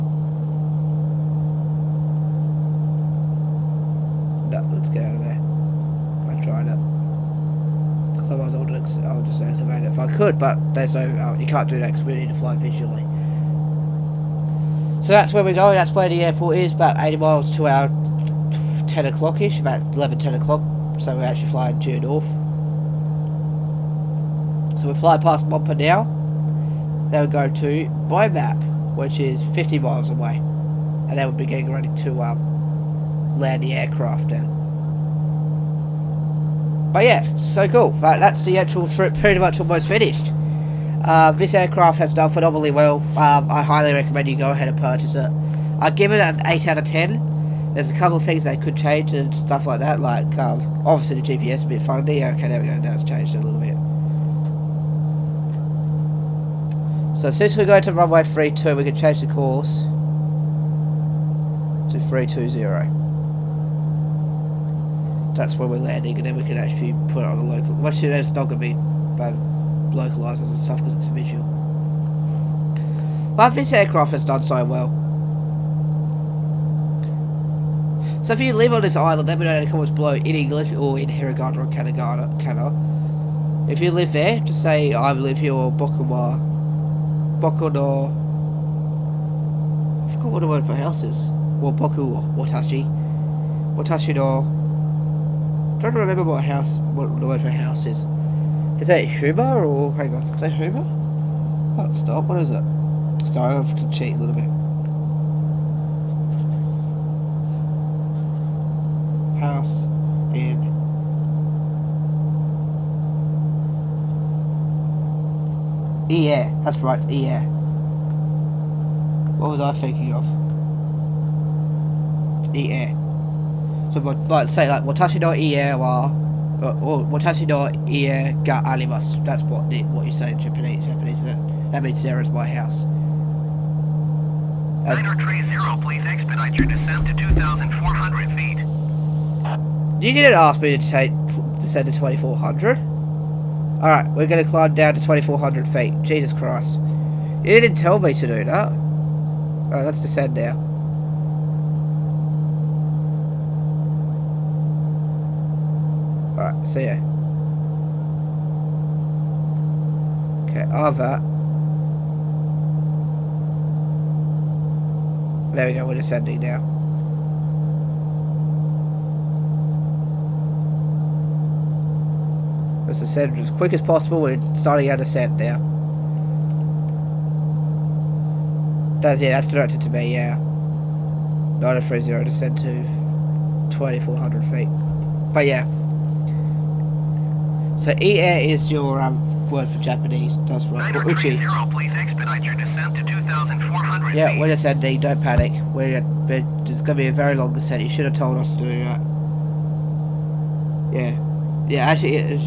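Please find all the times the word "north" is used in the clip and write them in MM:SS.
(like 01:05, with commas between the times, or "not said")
00:22.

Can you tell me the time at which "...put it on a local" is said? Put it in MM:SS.
01:07.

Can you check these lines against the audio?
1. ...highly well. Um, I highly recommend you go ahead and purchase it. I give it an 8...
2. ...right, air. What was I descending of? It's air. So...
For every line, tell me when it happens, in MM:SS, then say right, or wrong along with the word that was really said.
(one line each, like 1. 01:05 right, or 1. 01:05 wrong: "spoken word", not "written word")
1. 00:42 wrong: "phenomenally", not "highly"
2. 01:56 wrong: "thinking", not "descending".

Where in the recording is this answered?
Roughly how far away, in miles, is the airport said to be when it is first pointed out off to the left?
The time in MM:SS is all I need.
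00:16.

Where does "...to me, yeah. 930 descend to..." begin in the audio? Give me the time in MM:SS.
02:59.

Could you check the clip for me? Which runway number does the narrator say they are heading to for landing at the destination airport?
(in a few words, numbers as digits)
32.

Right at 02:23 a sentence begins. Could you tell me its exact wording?
Alright, we're going to climb down to 2,400 feet.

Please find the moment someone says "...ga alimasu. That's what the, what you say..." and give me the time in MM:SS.
02:08.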